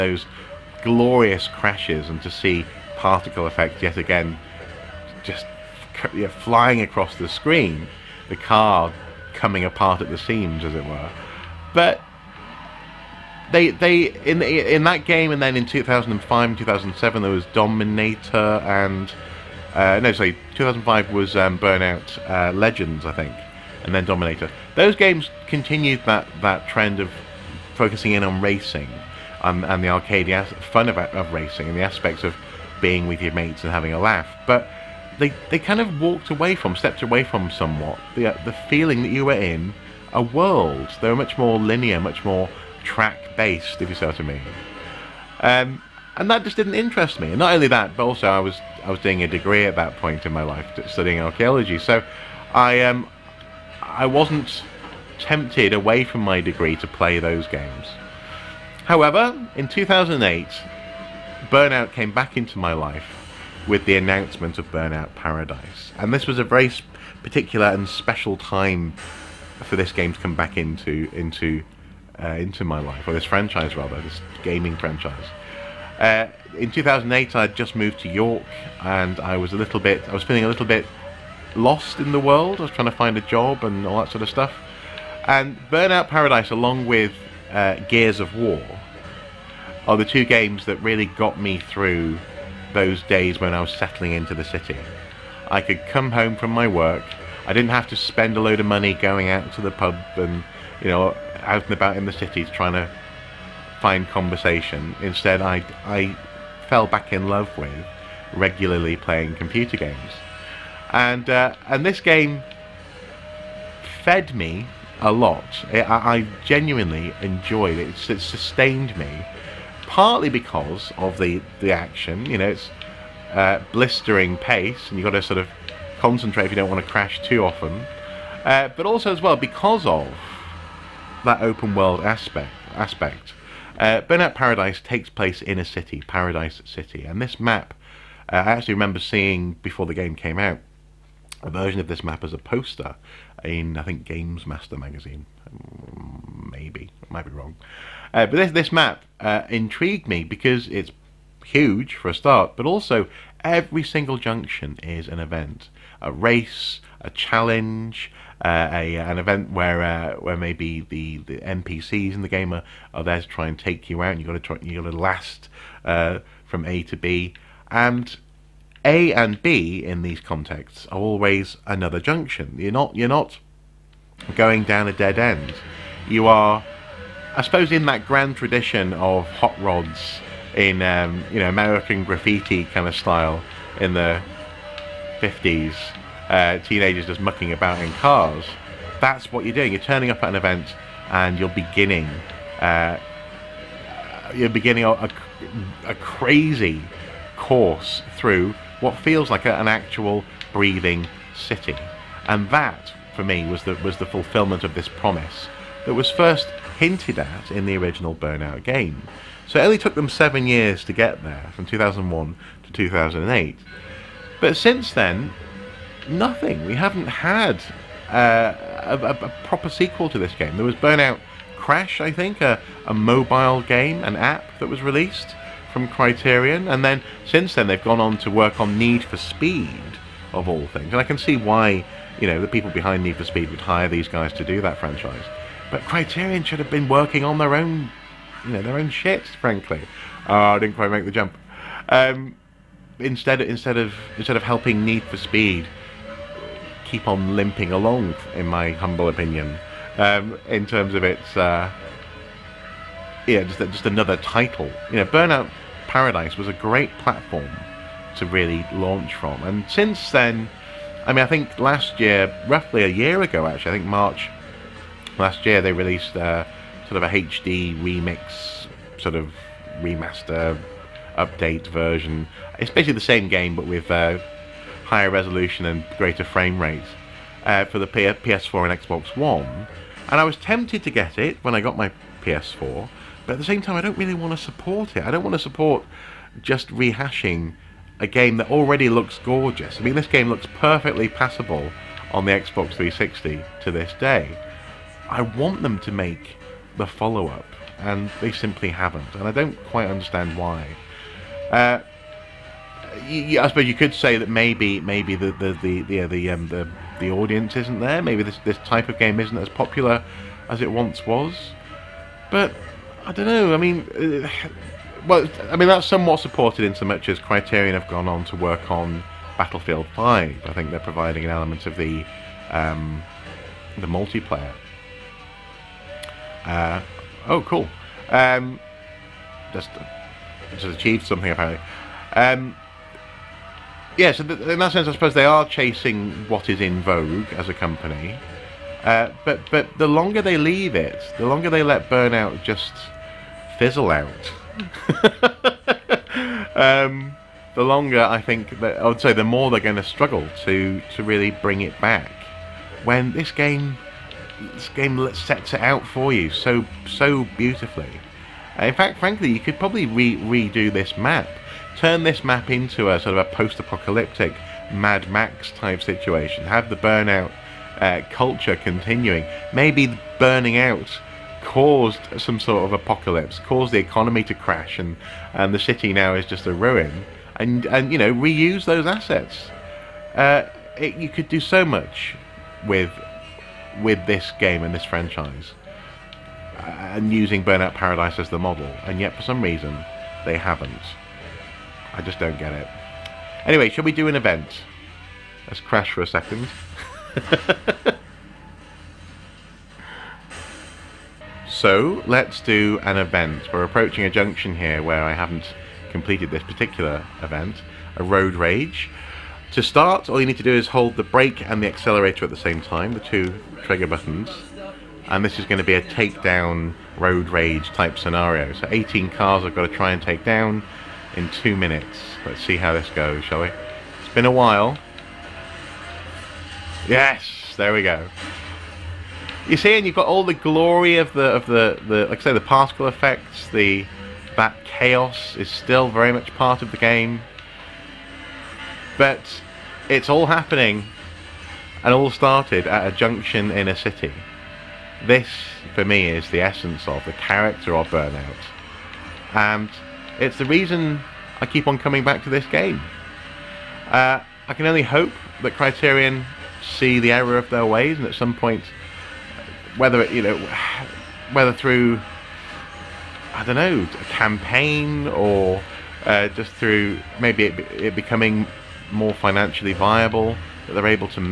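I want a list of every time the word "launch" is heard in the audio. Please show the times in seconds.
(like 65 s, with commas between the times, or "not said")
258 s.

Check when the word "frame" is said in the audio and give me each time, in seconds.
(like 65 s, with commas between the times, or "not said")
276 s.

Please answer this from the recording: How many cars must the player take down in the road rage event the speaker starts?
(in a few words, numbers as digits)
18.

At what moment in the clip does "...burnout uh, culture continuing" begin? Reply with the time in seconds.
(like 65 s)
366 s.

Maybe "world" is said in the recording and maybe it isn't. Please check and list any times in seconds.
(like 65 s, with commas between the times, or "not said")
40 s, 82 s, 131 s.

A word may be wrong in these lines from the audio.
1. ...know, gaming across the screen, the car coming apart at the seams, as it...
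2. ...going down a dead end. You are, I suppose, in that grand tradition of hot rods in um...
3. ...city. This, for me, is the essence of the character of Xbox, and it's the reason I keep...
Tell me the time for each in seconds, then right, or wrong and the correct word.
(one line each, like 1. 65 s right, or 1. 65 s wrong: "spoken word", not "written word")
1. 6 s wrong: "flying", not "gaming"
2. 174 s right
3. 443 s wrong: "Burnout", not "Xbox".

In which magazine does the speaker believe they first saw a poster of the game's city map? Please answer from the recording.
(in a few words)
Games Master.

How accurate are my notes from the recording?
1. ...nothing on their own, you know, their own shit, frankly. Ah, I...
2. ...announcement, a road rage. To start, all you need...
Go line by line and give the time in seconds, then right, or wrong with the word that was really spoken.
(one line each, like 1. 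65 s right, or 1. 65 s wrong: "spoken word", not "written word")
1. 236 s wrong: "working", not "nothing"
2. 407 s wrong: "event", not "announcement".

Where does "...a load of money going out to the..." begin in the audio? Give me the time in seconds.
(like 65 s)
98 s.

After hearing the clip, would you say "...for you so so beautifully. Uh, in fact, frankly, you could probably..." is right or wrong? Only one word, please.
right.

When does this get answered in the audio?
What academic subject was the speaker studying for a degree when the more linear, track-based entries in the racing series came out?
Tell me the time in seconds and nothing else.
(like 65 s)
51 s.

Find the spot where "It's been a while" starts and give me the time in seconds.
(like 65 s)
423 s.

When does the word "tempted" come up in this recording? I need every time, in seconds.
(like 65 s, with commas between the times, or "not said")
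55 s, 280 s.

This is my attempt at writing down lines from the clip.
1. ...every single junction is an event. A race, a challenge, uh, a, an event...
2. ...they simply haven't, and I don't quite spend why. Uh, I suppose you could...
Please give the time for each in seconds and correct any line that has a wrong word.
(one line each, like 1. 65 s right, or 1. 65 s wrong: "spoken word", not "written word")
1. 153 s right
2. 298 s wrong: "understand", not "spend".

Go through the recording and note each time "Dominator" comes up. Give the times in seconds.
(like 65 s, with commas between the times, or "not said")
17 s, 24 s.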